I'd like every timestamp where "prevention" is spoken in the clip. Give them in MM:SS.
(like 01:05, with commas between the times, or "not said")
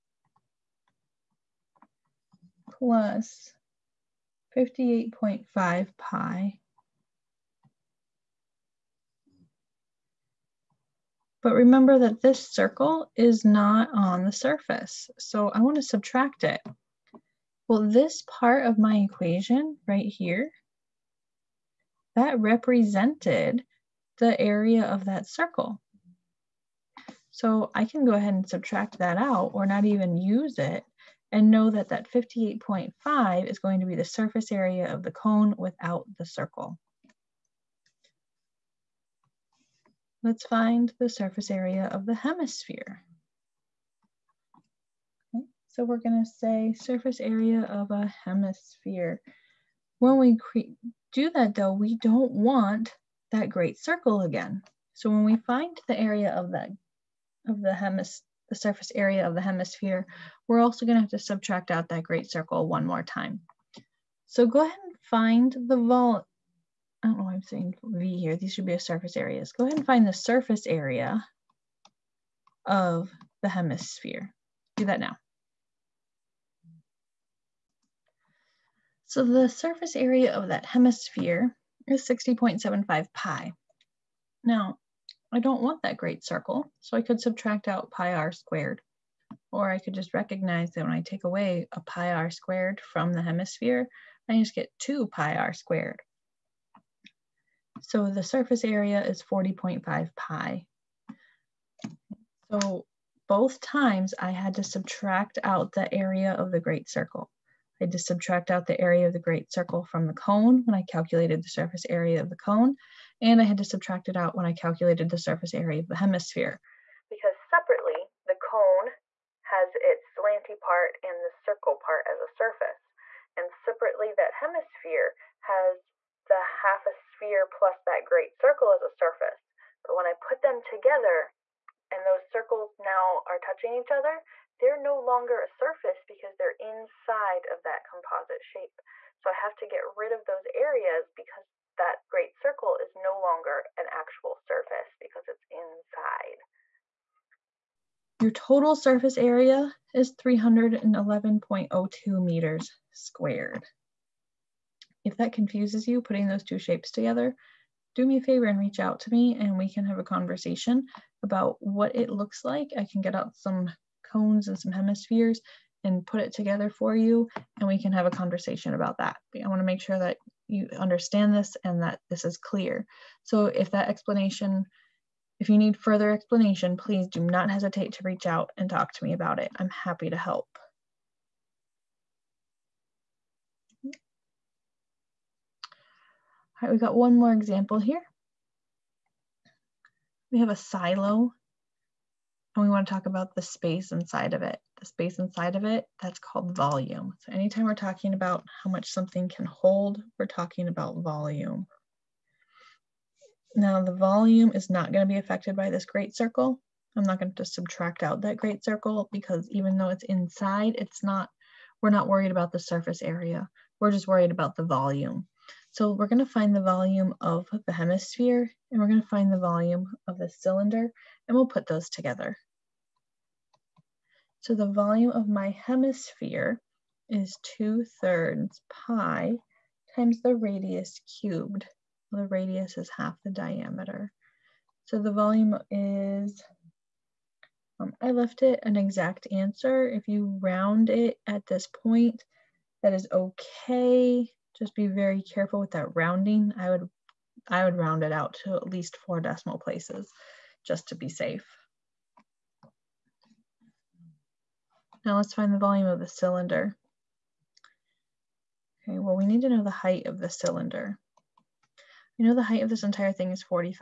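not said.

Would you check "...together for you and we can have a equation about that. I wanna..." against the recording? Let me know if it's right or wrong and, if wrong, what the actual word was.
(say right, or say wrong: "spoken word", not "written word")
wrong: "conversation", not "equation".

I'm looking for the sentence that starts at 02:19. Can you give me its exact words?
So I have to get rid of those areas because that great circle is no longer an actual surface because it's inside.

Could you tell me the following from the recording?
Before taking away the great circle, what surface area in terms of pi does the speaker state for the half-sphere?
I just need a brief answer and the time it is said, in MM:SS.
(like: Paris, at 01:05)
60.75 pi, at 01:22.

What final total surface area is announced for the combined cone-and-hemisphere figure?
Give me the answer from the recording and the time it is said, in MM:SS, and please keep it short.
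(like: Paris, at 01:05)
311.02 square meters, at 02:30.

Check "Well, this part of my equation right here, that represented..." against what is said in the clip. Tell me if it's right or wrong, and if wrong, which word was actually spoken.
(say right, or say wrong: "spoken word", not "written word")
right.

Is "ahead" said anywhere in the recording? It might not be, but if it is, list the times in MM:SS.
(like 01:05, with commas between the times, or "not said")
00:28, 01:04, 01:09.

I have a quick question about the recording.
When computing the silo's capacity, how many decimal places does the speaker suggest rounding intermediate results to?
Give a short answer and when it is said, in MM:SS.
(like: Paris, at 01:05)
4, at 04:08.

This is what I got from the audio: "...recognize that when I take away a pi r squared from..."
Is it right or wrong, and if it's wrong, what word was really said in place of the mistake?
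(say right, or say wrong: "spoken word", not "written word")
right.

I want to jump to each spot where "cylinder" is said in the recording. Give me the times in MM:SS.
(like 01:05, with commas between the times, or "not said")
03:40, 04:16, 04:20.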